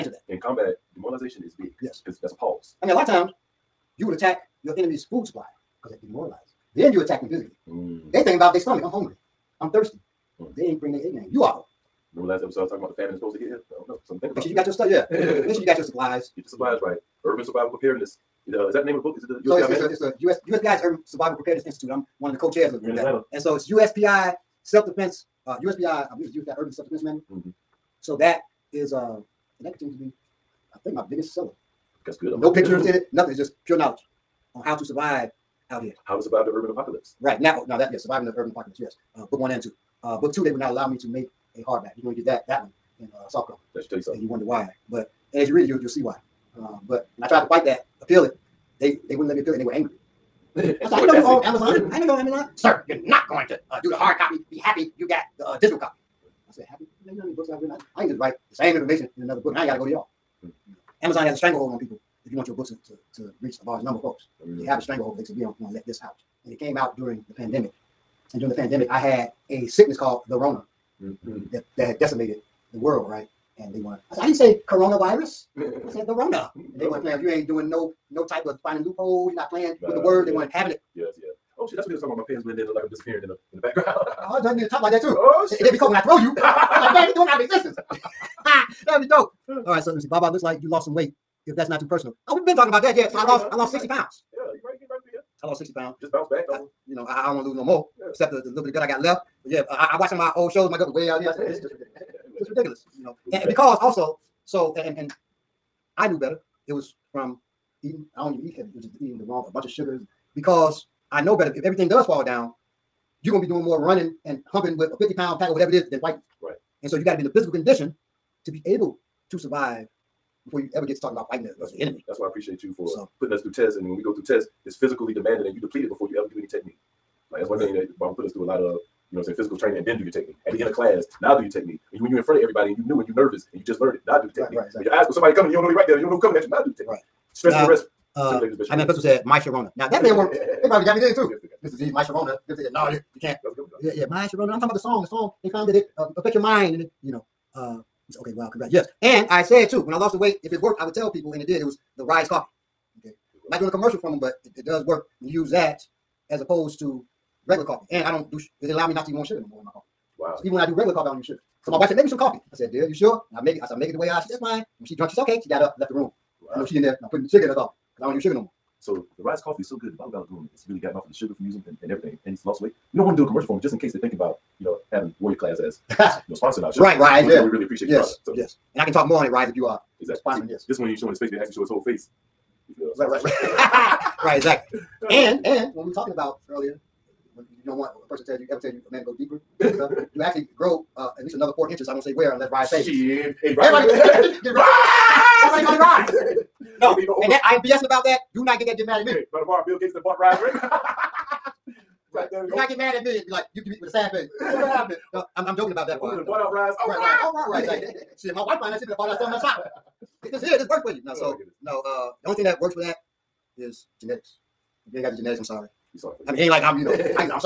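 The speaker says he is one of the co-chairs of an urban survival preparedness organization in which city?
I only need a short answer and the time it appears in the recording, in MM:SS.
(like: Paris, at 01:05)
Atlanta, at 00:23.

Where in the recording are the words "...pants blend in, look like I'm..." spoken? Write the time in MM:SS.
01:22.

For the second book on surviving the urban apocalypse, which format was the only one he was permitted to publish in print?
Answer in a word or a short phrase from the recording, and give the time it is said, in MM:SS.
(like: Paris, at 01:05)
Soft cover, at 00:43.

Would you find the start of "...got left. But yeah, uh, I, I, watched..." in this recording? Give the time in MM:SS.
01:38.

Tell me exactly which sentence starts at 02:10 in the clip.
At the end of class, now do your technique.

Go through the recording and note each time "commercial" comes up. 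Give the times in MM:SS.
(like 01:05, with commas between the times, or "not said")
02:33, 02:53.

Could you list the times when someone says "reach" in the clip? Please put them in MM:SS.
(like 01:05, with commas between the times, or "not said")
01:03.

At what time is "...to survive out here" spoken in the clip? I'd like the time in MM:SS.
00:34.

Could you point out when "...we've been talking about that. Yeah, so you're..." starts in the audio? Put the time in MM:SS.
01:32.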